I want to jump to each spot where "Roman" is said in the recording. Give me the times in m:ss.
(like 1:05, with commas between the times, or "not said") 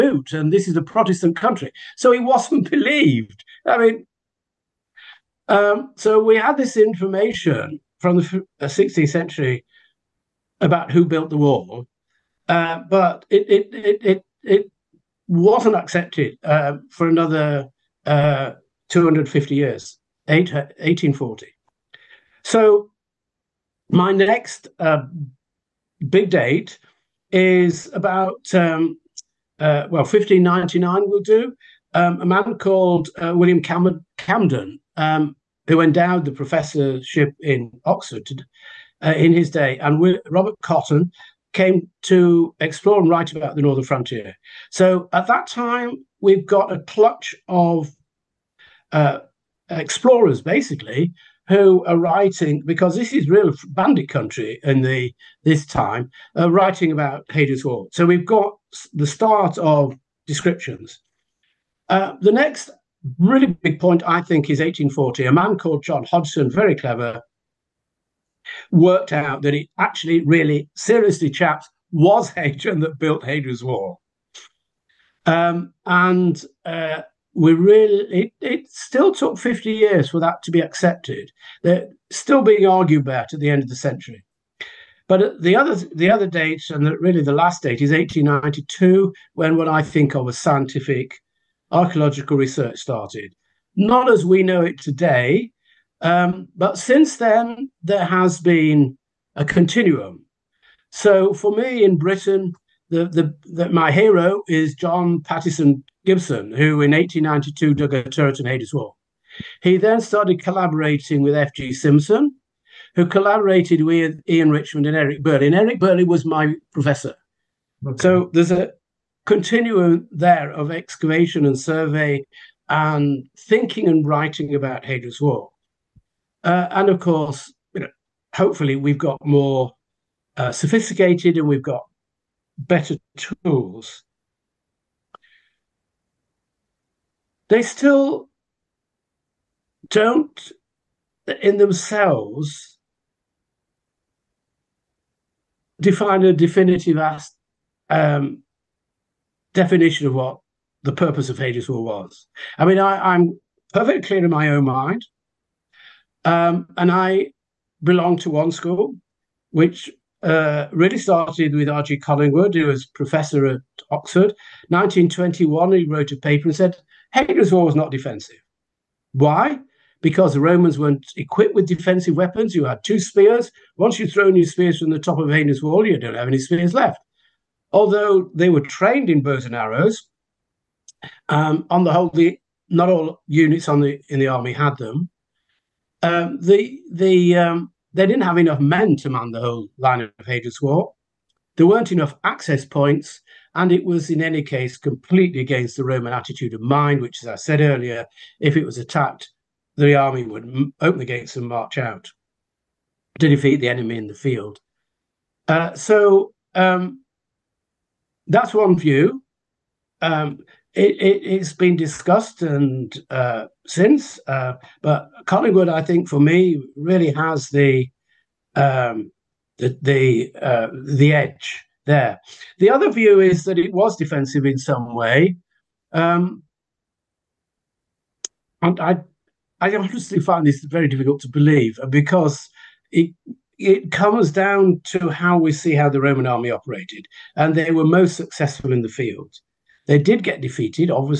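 2:50, 3:15, 3:55.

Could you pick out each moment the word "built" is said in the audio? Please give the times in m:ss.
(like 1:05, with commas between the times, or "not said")
0:11, 1:12.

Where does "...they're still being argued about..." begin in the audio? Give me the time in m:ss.
1:21.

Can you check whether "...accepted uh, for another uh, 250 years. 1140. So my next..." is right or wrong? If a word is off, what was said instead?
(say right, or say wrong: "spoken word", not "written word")
wrong: "1840", not "1140".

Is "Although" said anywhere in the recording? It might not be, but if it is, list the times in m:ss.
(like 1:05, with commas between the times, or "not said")
2:57.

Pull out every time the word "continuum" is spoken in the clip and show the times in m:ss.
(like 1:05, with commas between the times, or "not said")
1:39, 1:59.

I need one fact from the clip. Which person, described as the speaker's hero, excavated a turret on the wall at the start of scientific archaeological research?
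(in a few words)
John Pattison Gibson.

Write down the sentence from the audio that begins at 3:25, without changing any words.
Uh, so um, that's one view.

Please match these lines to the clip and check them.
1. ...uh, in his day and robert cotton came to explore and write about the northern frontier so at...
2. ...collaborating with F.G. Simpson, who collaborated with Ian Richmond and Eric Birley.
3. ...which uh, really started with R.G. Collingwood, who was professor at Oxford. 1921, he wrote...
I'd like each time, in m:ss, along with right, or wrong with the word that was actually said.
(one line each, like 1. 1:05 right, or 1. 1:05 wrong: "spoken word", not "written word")
1. 0:39 right
2. 1:50 right
3. 2:39 right.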